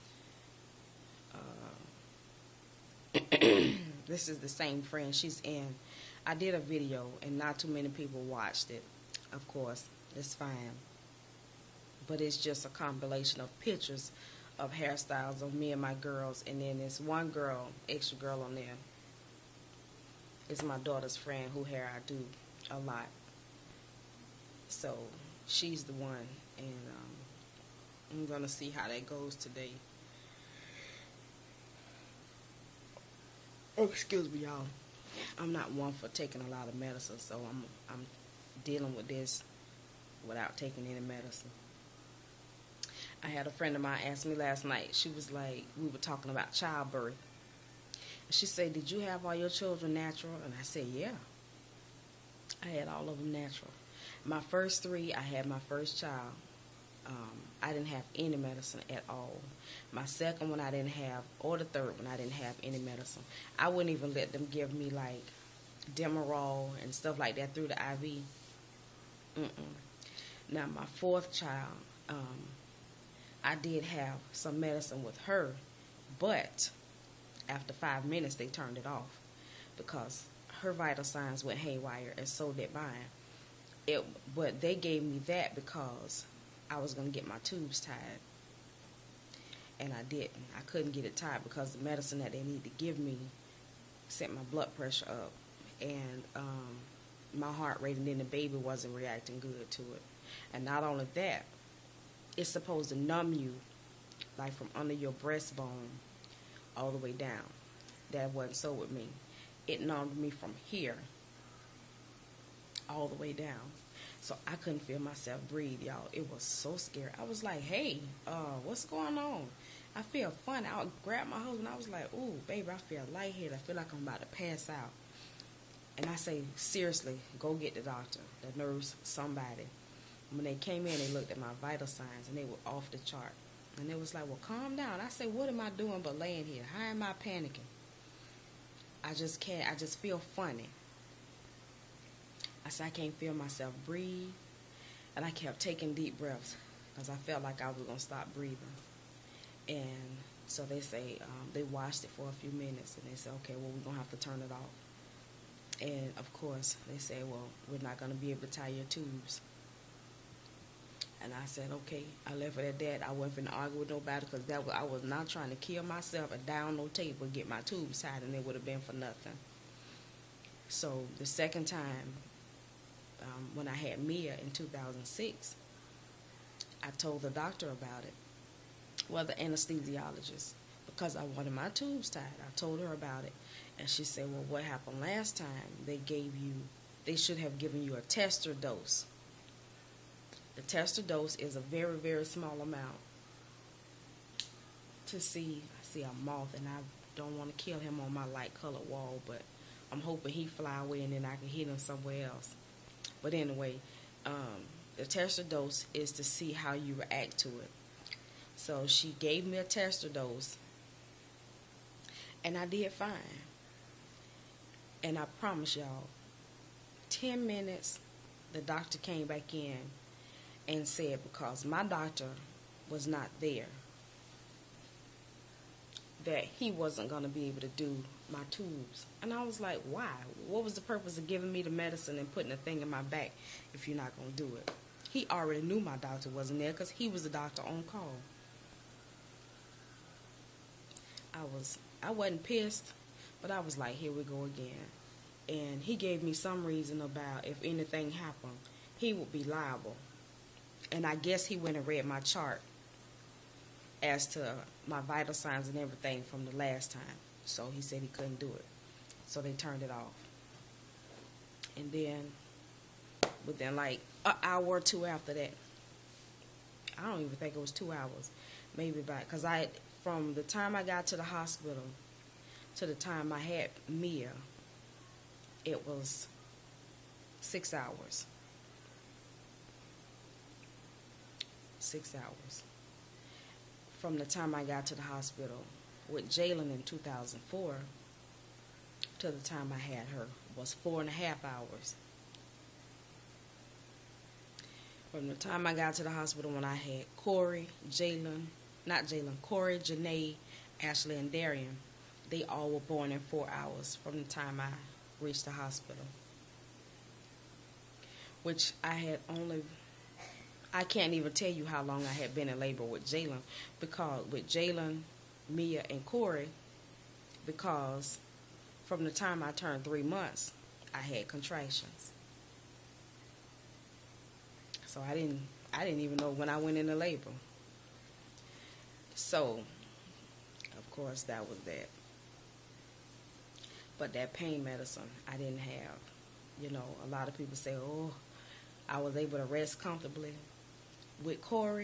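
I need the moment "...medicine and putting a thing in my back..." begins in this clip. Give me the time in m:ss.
3:51.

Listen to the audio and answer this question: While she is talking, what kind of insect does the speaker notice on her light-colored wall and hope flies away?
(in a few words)
moth.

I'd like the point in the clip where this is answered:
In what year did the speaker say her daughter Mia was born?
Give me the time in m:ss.
2:54.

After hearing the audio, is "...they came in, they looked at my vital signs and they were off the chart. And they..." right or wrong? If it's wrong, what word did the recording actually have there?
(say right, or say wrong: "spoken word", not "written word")
right.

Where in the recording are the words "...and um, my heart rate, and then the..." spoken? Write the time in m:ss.
1:35.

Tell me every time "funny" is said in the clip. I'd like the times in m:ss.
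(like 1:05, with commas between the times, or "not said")
2:00, 2:20.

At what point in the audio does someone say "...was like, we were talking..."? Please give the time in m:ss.
0:45.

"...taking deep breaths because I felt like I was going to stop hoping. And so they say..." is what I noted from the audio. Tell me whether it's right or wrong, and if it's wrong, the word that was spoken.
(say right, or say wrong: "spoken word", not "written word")
wrong: "breathing", not "hoping".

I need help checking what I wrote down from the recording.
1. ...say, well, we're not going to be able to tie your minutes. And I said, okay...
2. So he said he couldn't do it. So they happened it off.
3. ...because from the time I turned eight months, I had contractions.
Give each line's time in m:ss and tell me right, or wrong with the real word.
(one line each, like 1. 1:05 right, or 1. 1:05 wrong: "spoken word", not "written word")
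1. 2:36 wrong: "tubes", not "minutes"
2. 4:17 wrong: "turned", not "happened"
3. 5:17 wrong: "three", not "eight".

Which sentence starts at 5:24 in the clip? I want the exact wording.
So I didn't I didn't even know when I went into labor.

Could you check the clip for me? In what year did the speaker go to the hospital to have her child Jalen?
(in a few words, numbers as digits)
2004.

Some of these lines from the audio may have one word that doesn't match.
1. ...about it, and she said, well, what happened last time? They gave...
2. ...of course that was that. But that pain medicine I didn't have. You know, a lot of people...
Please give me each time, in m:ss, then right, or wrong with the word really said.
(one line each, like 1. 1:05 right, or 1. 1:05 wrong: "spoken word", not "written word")
1. 3:02 right
2. 5:30 right.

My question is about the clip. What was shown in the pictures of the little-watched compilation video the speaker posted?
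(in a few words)
hairstyles.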